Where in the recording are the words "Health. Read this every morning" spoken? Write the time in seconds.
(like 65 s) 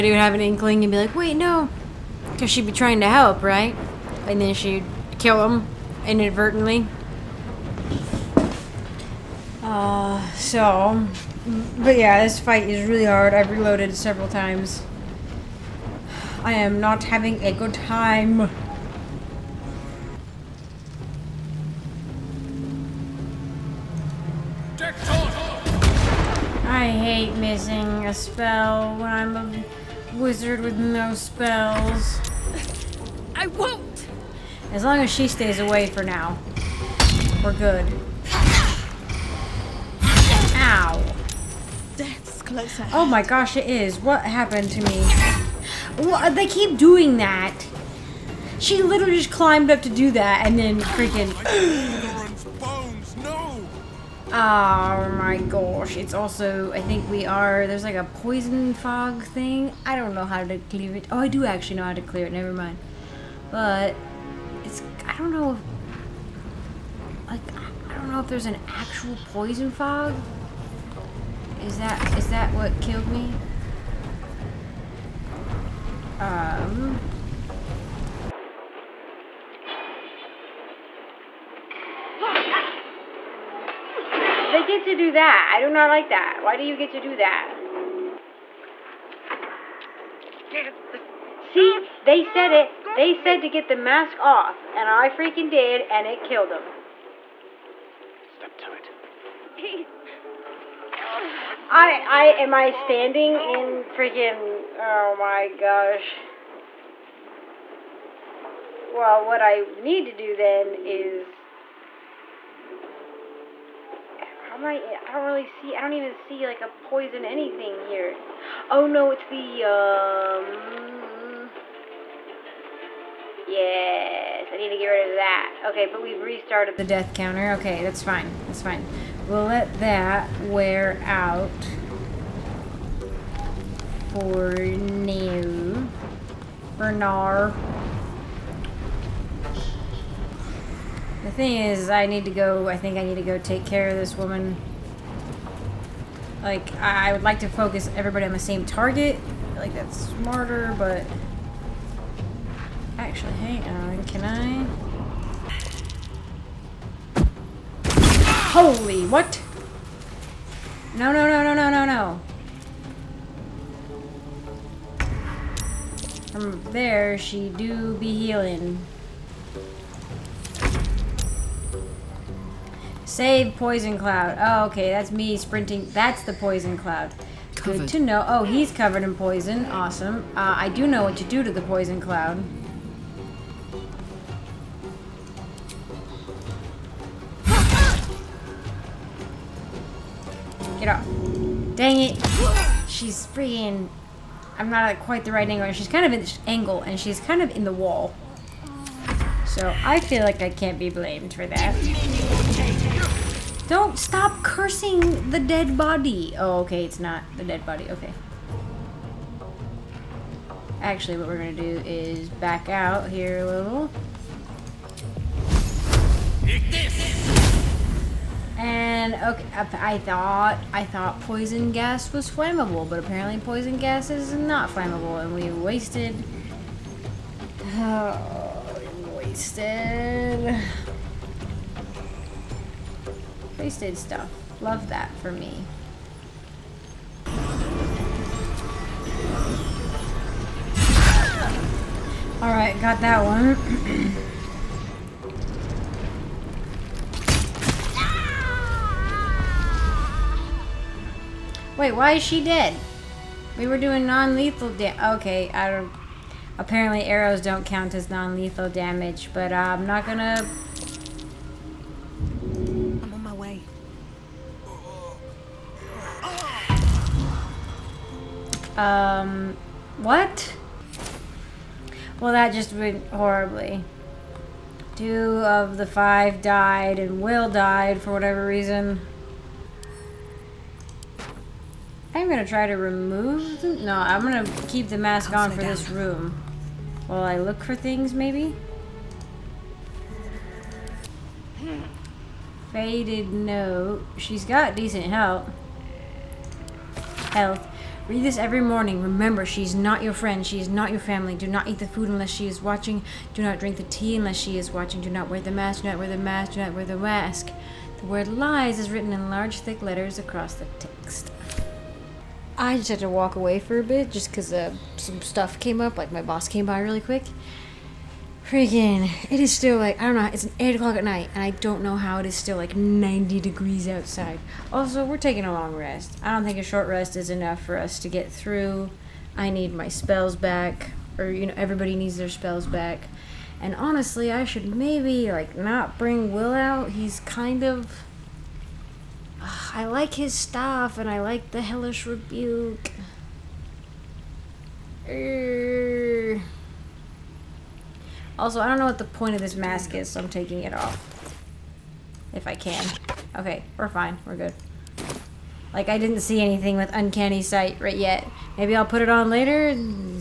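297 s.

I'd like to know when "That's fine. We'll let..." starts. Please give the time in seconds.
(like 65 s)
128 s.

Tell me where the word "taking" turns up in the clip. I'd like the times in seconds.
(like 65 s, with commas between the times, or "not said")
325 s, 350 s.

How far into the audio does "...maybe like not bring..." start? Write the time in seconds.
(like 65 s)
334 s.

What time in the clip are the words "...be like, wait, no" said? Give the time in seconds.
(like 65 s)
0 s.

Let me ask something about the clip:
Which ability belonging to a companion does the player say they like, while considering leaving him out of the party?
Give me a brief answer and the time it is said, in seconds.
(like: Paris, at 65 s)
hellish rebuke, at 341 s.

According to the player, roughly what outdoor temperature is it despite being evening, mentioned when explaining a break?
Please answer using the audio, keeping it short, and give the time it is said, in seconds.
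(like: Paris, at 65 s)
90 degrees, at 322 s.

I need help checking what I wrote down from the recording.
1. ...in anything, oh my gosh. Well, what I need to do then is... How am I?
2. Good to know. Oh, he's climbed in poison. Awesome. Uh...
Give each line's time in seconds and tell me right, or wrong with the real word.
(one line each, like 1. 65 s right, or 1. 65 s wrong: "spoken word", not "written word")
1. 103 s wrong: "freaking", not "anything"
2. 177 s wrong: "covered", not "climbed".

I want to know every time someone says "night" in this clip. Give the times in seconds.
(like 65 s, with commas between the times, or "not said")
321 s.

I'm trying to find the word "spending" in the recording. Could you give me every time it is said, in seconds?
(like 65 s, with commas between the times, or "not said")
not said.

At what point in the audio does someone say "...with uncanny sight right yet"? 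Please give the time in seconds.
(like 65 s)
356 s.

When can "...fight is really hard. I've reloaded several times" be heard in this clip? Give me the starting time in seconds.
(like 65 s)
12 s.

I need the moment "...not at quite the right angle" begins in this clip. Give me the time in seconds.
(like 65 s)
194 s.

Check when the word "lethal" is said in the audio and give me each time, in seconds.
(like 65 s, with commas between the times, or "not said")
254 s, 258 s.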